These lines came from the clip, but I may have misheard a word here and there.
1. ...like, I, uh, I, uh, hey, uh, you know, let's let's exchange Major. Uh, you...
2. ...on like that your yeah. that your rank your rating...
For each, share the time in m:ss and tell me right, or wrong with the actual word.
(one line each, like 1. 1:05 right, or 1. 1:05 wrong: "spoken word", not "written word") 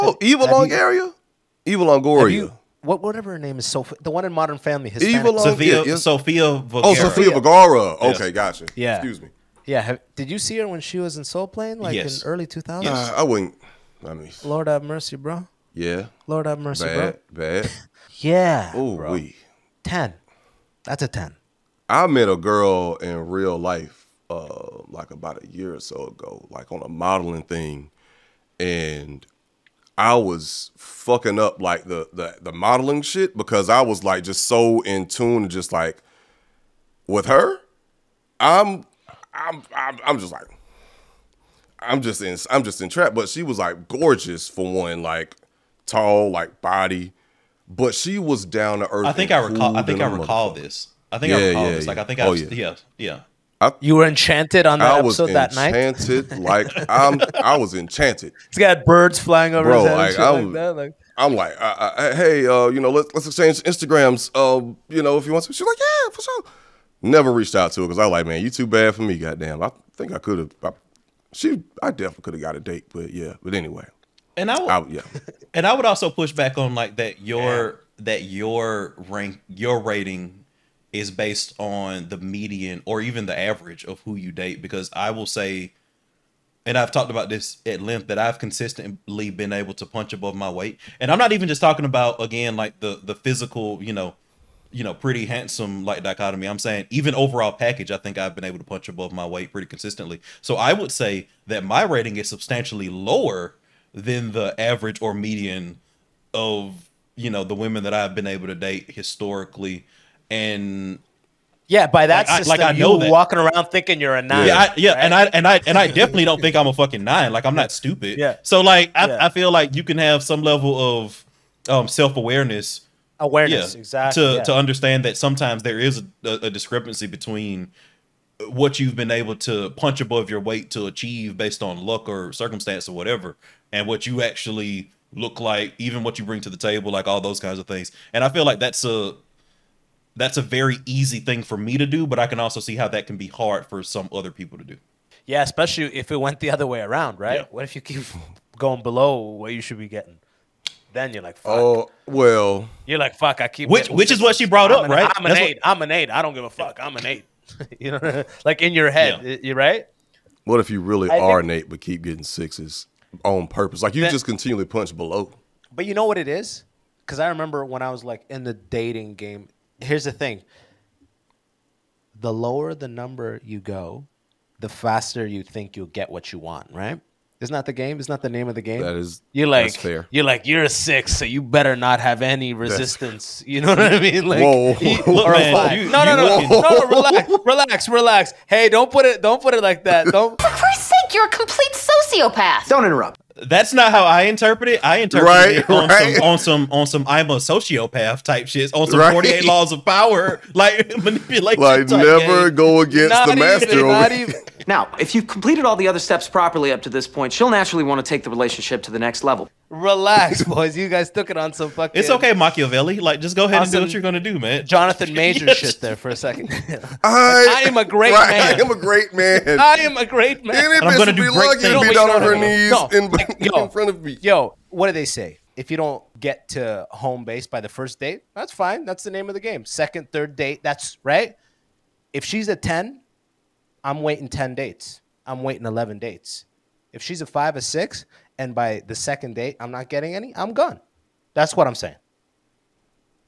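1. 1:01 wrong: "Instagrams", not "Major"
2. 1:16 right.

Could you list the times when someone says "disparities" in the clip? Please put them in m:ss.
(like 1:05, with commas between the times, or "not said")
not said.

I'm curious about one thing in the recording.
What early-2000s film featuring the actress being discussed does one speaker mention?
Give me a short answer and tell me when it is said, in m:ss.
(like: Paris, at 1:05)
Soul Plane, at 0:11.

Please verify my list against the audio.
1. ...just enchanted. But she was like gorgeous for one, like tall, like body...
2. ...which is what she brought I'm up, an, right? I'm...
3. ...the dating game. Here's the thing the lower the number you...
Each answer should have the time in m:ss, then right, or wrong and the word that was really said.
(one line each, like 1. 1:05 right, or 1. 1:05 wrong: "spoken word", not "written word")
1. 0:42 wrong: "entrapped", not "enchanted"
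2. 2:33 right
3. 2:48 right.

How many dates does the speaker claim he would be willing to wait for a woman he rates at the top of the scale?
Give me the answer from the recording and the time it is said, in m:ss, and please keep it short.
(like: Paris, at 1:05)
11, at 3:55.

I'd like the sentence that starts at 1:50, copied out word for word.
And yeah, by that like, system, I, like I know you that.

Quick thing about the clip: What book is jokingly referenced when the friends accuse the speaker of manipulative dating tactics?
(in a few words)
48 Laws of Power.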